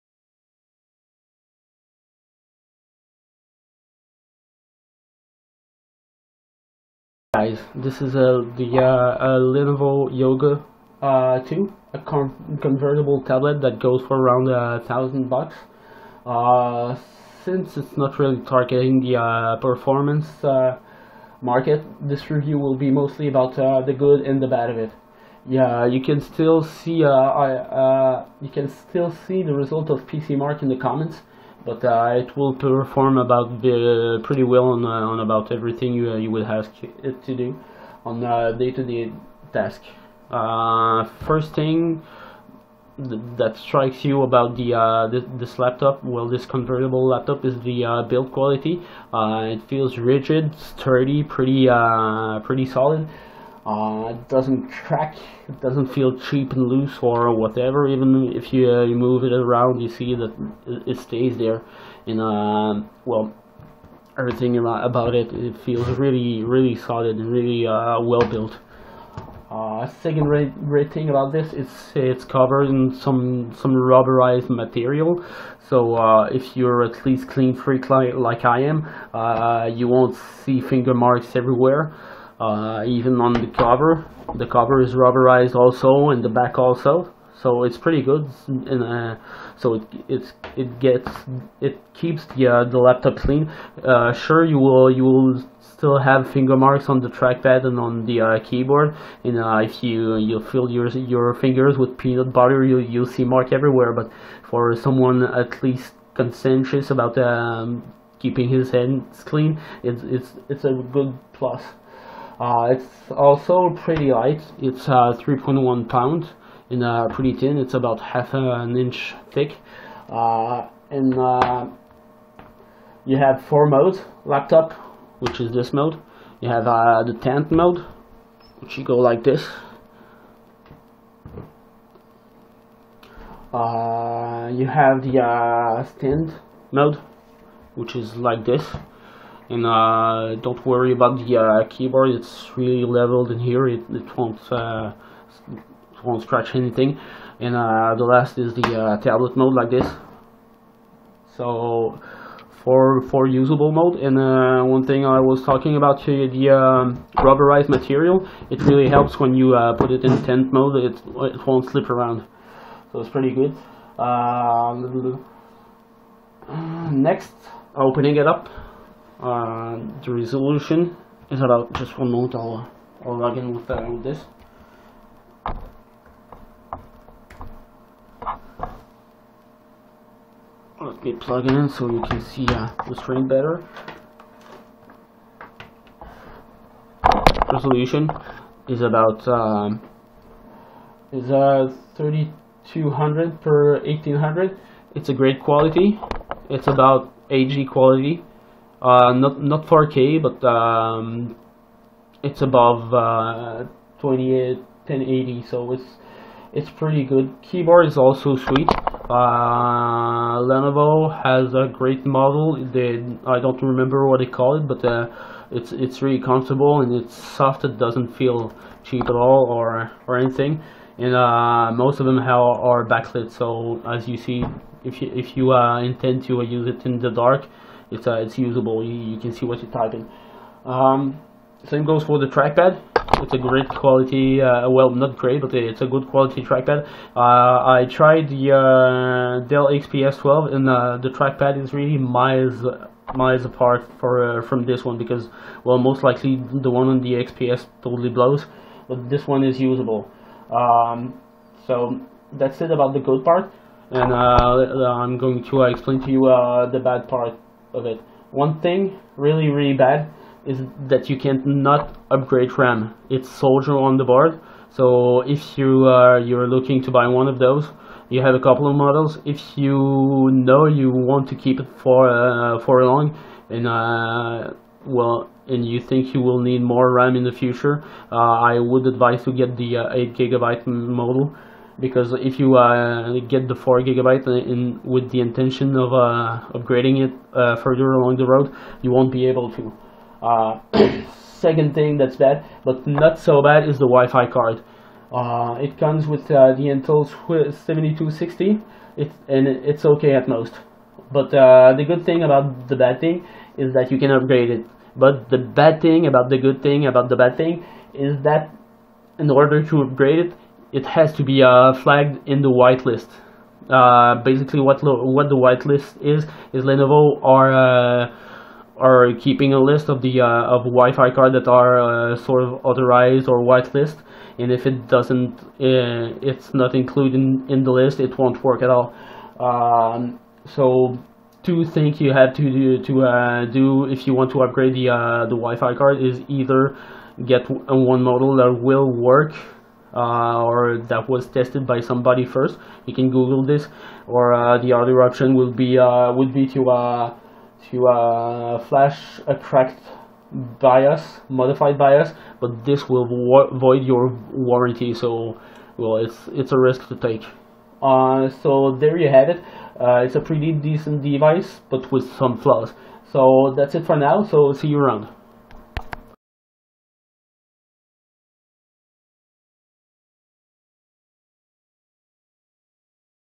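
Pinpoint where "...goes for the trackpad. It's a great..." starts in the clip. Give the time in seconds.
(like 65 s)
231 s.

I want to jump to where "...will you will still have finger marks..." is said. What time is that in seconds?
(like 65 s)
94 s.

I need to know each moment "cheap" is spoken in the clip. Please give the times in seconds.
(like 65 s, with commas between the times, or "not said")
56 s, 218 s.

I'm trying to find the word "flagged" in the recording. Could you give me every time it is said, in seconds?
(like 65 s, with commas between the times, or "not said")
311 s.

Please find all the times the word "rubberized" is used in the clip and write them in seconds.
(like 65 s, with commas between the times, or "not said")
73 s, 84 s, 157 s.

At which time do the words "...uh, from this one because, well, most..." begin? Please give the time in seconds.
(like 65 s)
244 s.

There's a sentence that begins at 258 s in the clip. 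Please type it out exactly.
One thing really really bad is that you can't not upgrade RAM.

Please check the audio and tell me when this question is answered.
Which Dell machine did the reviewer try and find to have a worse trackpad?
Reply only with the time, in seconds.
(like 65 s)
239 s.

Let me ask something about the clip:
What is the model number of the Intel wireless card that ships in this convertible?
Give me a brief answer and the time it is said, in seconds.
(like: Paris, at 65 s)
7260, at 297 s.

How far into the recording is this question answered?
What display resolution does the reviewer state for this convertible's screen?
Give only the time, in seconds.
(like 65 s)
191 s.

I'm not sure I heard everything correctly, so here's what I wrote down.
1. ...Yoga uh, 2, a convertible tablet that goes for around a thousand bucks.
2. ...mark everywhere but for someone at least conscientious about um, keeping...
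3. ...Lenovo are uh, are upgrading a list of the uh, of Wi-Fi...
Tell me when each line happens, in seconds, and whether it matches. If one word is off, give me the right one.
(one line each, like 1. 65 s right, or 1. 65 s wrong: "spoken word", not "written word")
1. 10 s right
2. 103 s right
3. 316 s wrong: "keeping", not "upgrading".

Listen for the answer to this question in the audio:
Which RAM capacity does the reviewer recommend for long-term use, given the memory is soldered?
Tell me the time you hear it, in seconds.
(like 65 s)
279 s.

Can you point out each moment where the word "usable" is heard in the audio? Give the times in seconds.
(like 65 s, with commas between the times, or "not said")
153 s, 228 s, 249 s.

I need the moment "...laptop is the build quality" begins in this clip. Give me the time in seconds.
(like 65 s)
47 s.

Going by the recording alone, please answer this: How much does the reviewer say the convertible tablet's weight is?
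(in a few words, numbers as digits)
3.1 pounds.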